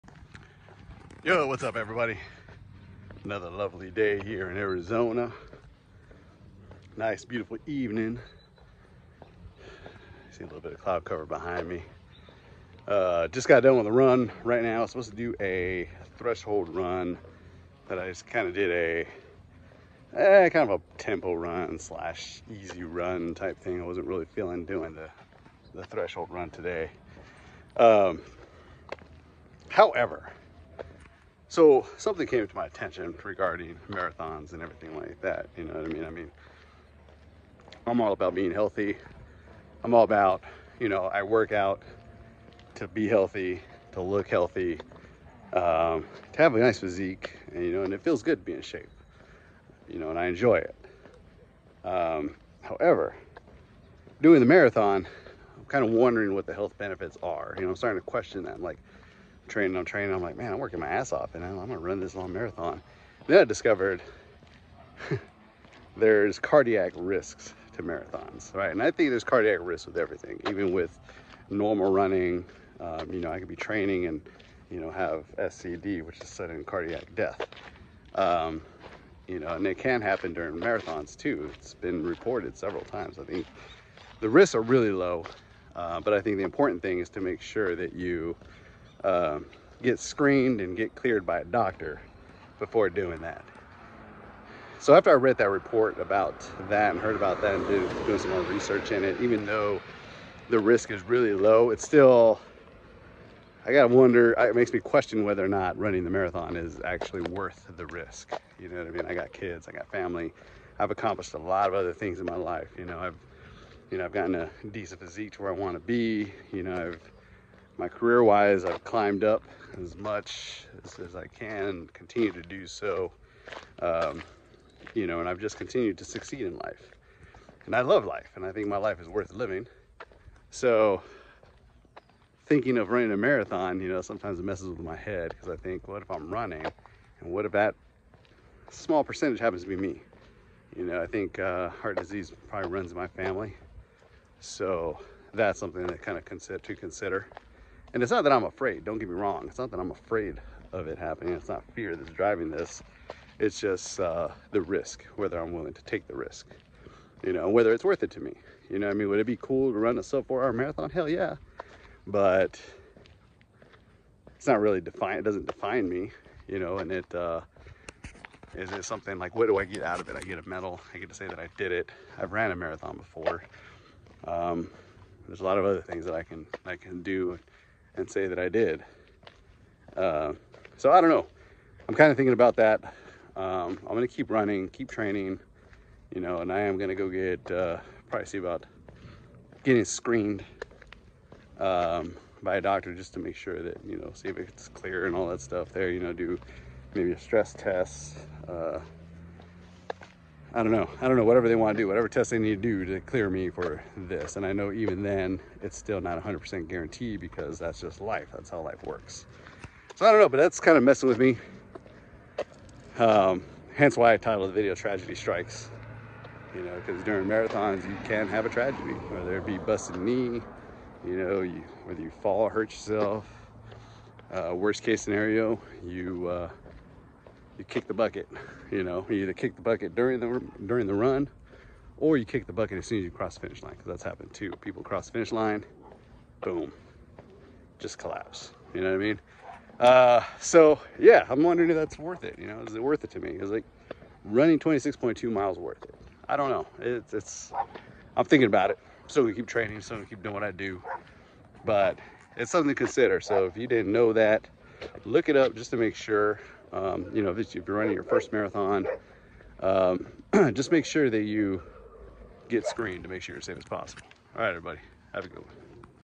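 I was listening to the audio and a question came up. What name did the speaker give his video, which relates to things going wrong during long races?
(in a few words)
Tragedy Strikes.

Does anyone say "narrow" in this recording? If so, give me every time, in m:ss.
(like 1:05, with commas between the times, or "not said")
not said.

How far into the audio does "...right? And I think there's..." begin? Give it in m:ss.
1:08.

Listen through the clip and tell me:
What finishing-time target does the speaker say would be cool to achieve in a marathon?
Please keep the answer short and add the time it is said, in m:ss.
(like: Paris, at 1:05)
sub four hour, at 2:40.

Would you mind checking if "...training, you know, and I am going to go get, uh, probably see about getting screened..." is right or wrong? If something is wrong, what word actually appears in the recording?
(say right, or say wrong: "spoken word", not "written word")
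right.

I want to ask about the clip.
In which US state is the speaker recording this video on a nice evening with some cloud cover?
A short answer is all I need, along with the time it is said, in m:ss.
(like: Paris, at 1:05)
Arizona, at 0:04.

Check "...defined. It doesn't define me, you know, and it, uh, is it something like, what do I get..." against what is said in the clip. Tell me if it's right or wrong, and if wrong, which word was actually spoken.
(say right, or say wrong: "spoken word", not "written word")
right.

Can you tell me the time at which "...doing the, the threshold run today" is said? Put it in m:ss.
0:24.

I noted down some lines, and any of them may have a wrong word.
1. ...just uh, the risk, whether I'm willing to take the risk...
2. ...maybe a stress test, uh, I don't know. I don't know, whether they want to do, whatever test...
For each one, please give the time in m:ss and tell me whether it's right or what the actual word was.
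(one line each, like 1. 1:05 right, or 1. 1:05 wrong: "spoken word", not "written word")
1. 2:33 right
2. 3:16 wrong: "whatever", not "whether".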